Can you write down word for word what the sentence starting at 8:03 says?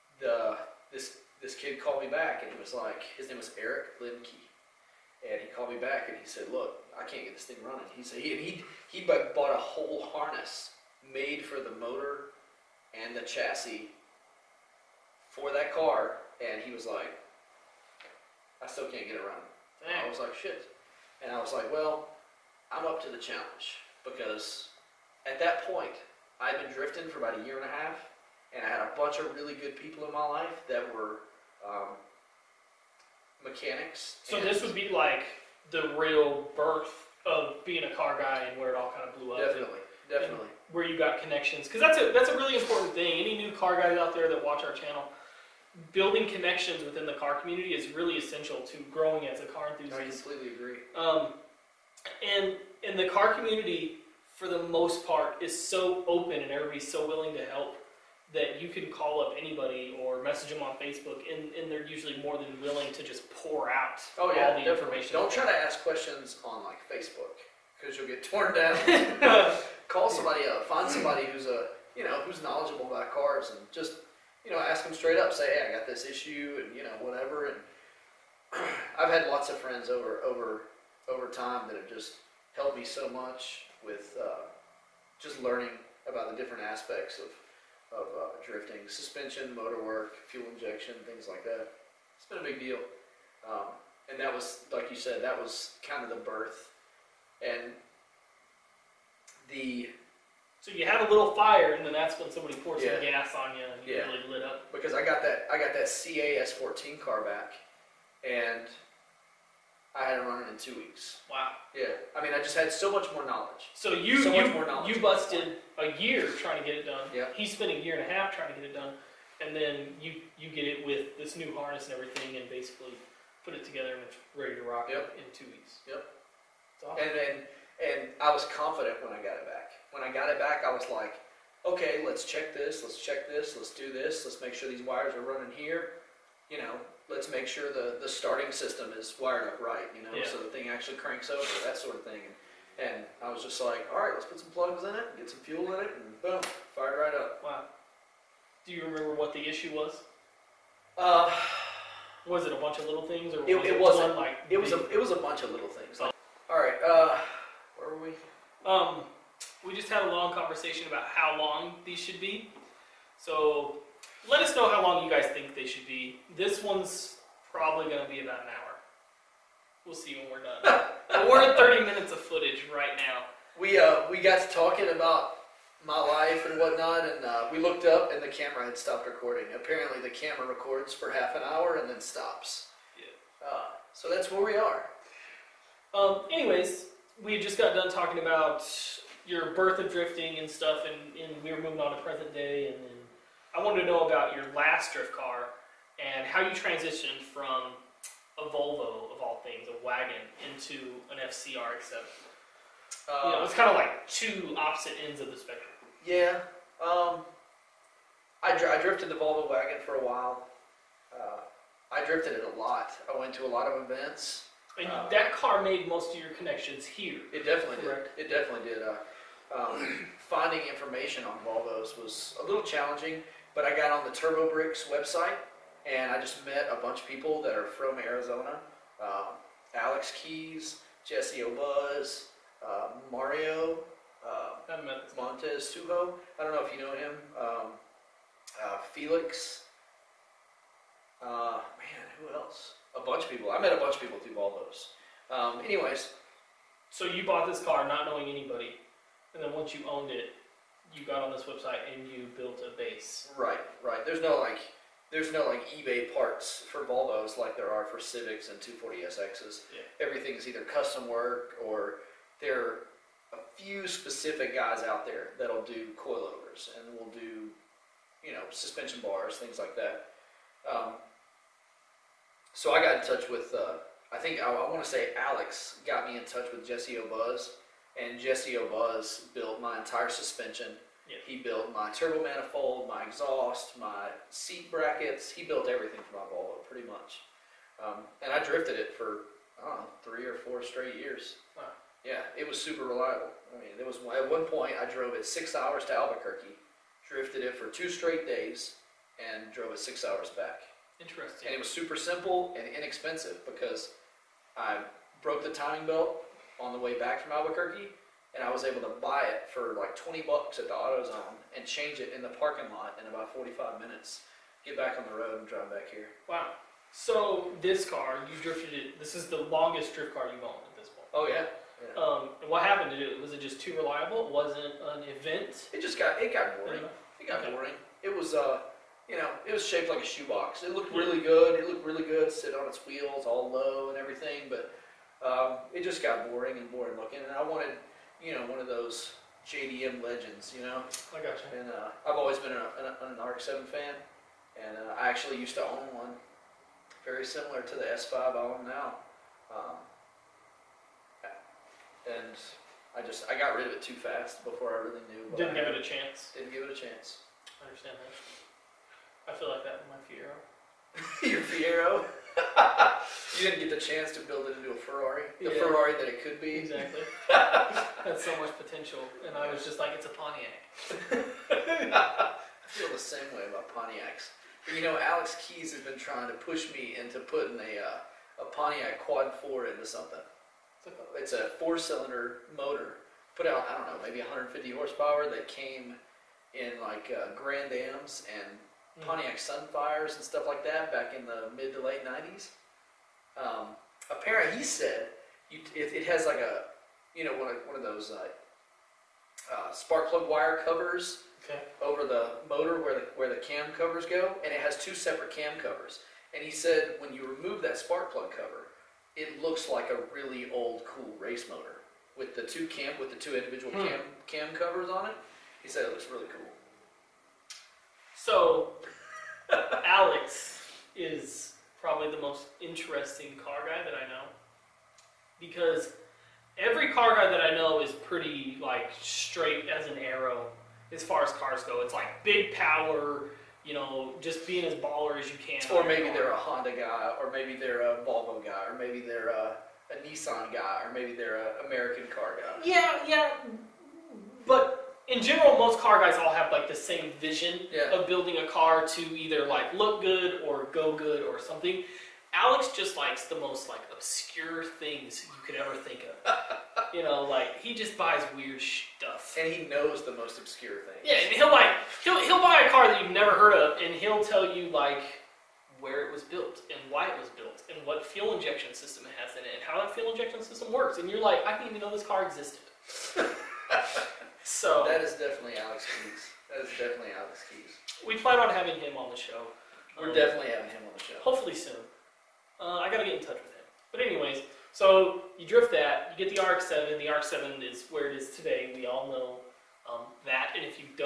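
But anyways, so you drift that, you get the RX-7.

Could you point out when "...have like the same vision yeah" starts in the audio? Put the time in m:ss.
7:26.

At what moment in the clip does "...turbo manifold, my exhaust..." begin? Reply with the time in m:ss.
4:41.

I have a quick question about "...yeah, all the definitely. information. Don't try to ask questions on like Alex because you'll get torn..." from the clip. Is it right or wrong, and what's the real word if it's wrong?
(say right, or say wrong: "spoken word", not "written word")
wrong: "Facebook", not "Alex".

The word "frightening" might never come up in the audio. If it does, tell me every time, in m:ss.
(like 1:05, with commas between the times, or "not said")
not said.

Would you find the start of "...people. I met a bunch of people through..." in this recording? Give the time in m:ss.
4:03.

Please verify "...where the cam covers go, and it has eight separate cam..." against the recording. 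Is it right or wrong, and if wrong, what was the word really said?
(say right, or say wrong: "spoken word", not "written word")
wrong: "two", not "eight".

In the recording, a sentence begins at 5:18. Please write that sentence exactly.
This is the longest drift car you've owned at this point.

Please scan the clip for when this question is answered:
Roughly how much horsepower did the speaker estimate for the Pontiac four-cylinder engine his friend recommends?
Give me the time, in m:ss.
6:24.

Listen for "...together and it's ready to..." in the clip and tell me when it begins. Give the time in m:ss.
2:03.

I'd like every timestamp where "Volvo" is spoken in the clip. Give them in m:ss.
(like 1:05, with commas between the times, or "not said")
3:18, 3:29, 3:41, 4:16, 4:46, 7:17.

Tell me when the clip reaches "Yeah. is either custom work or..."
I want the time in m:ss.
4:20.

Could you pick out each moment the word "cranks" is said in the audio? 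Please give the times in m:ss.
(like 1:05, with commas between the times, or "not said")
2:20.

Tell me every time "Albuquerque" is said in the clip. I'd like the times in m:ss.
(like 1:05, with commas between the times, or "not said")
4:55, 5:07.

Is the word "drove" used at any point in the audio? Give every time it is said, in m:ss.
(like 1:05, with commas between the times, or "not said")
4:54, 4:59.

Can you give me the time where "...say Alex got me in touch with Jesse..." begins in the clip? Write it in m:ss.
4:34.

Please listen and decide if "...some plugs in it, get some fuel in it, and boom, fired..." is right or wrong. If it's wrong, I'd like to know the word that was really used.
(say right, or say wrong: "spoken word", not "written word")
right.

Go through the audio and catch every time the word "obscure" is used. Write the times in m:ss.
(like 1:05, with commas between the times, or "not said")
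7:33, 7:40.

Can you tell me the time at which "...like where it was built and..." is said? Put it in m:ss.
7:44.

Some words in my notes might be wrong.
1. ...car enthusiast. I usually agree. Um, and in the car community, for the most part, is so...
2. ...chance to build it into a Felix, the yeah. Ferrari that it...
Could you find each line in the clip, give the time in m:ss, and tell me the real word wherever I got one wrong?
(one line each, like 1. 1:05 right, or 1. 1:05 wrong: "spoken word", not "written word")
1. 0:49 wrong: "completely", not "usually"
2. 6:03 wrong: "Ferrari", not "Felix".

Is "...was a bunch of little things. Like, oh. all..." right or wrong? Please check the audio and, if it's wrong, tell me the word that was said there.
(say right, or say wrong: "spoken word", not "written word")
right.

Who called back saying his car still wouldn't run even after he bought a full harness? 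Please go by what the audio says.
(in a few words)
Eric Limke.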